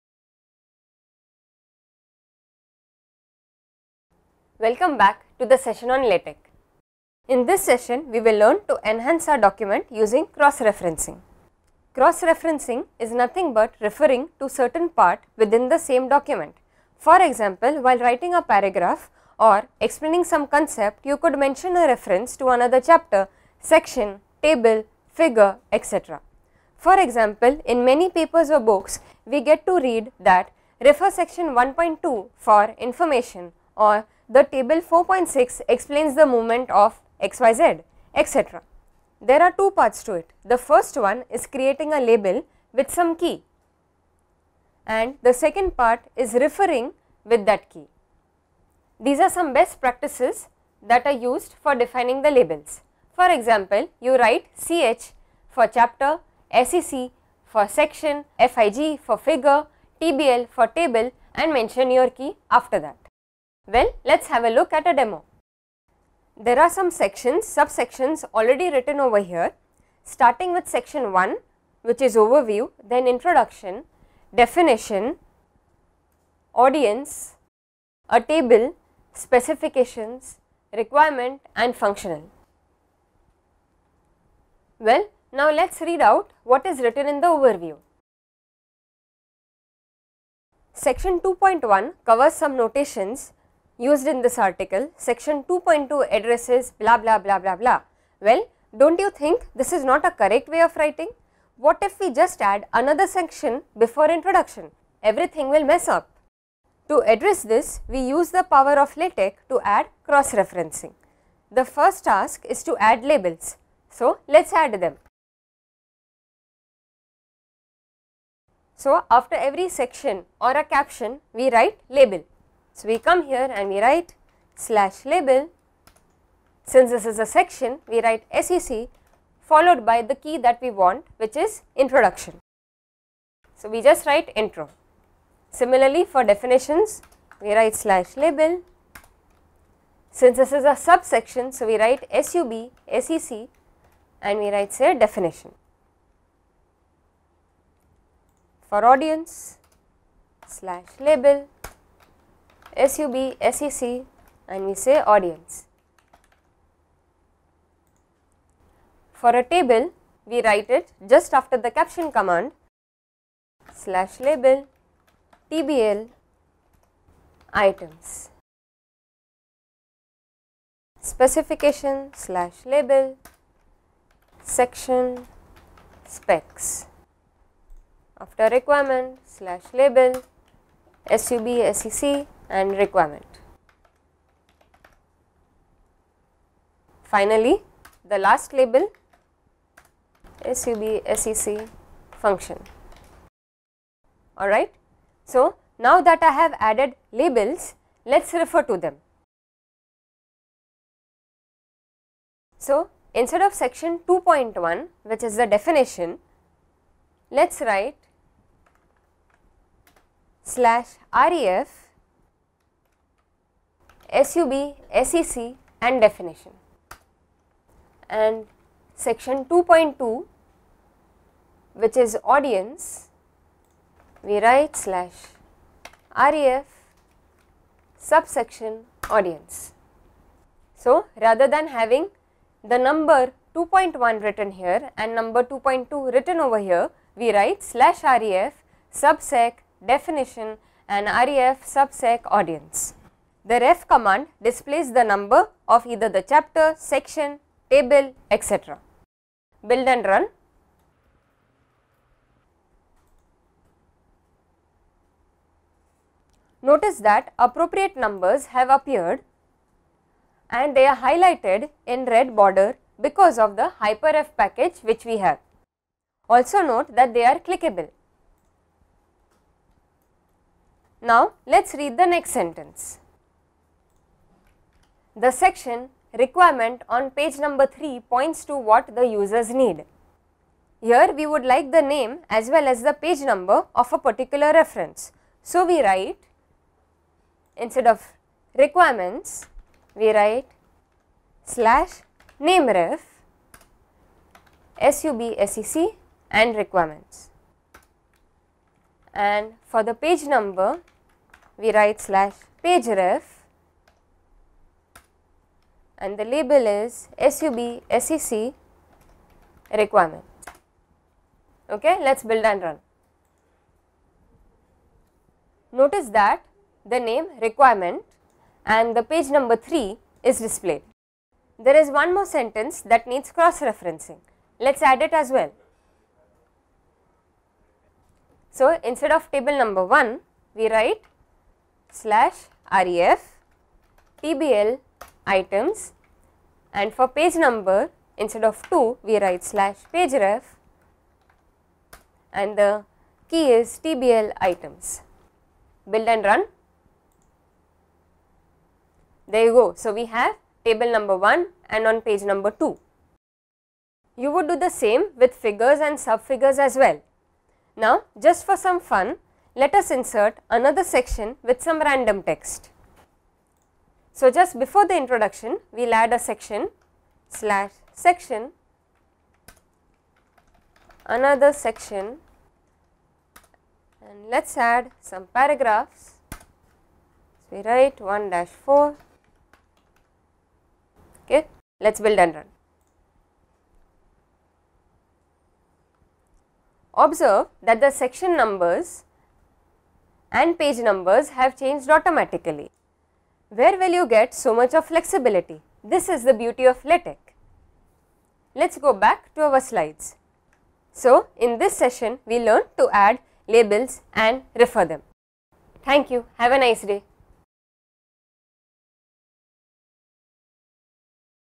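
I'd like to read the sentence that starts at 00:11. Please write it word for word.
Cross-referencing is nothing but referring to certain part within the same document.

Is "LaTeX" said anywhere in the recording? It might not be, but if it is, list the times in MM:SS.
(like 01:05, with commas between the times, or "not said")
00:06, 01:48, 06:36.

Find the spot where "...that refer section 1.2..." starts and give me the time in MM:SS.
00:30.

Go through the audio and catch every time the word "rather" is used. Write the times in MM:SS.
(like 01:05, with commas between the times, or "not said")
03:51.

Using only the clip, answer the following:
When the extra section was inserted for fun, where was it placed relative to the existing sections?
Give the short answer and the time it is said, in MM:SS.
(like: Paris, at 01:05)
before the introduction, at 06:04.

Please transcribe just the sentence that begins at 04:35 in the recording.
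The section requirement on page number 3 points to what the users need.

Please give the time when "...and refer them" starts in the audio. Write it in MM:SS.
06:44.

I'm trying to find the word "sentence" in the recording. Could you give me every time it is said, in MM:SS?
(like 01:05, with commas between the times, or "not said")
04:32, 05:22.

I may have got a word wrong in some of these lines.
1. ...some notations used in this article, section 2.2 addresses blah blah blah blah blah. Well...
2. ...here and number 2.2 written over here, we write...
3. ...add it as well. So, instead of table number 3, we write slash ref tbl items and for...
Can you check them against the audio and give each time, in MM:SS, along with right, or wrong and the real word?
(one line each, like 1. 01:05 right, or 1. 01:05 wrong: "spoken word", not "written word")
1. 01:32 right
2. 03:54 right
3. 05:24 wrong: "1", not "3".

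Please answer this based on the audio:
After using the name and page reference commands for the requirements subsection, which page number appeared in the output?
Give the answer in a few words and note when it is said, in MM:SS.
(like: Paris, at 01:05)
3, at 05:18.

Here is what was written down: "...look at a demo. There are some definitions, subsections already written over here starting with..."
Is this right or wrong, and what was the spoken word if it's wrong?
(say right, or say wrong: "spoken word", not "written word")
wrong: "sections", not "definitions".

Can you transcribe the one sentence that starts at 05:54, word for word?
You would do the same with figures and subfigures as well.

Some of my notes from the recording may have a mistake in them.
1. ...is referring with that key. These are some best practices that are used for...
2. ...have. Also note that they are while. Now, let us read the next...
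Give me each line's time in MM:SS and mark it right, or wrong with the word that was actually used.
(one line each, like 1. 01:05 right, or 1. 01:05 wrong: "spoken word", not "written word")
1. 00:46 right
2. 04:25 wrong: "clickable", not "while".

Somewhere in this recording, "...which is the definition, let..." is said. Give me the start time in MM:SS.
03:25.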